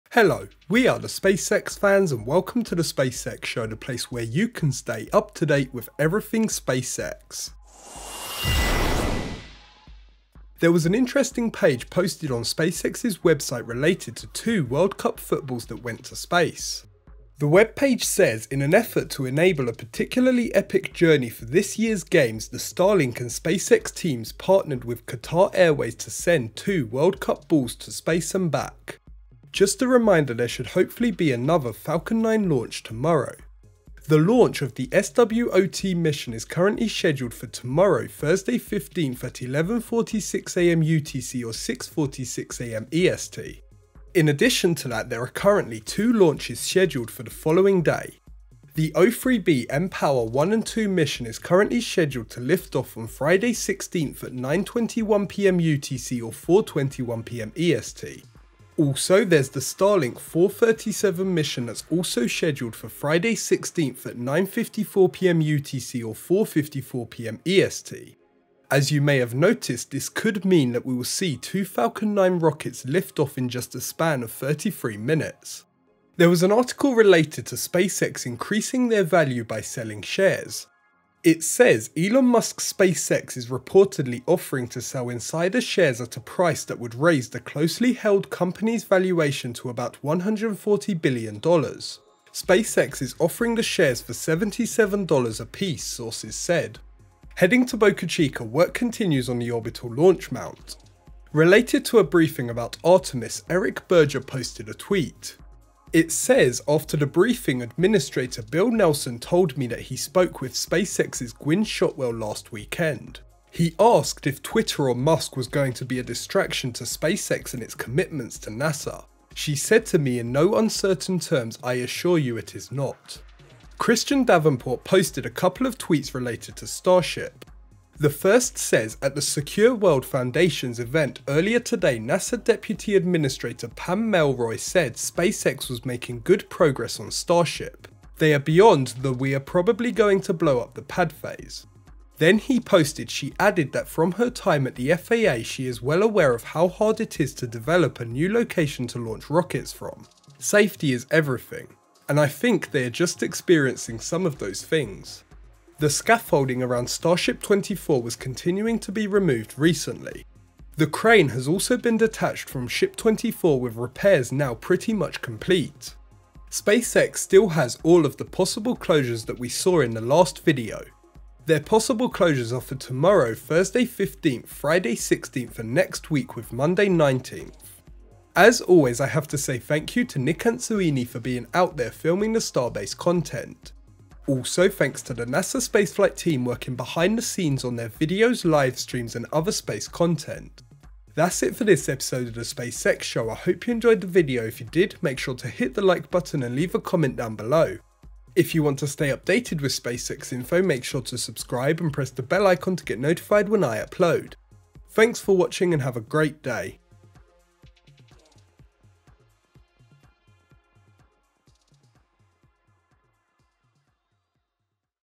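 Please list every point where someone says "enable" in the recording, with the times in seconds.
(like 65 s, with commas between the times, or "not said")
19 s.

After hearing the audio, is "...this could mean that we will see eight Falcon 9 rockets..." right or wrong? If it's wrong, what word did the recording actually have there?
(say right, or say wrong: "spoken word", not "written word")
wrong: "two", not "eight".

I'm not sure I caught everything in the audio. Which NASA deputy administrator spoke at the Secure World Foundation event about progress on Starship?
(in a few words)
Pam Melroy.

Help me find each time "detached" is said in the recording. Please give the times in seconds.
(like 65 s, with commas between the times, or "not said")
161 s.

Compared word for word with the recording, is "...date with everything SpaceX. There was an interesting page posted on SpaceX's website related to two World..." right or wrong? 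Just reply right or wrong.
right.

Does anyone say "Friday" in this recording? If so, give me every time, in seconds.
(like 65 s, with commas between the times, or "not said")
53 s, 62 s, 174 s.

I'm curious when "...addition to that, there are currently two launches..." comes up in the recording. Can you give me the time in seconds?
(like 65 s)
44 s.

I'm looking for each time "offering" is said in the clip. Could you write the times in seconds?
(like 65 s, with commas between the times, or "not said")
84 s, 93 s.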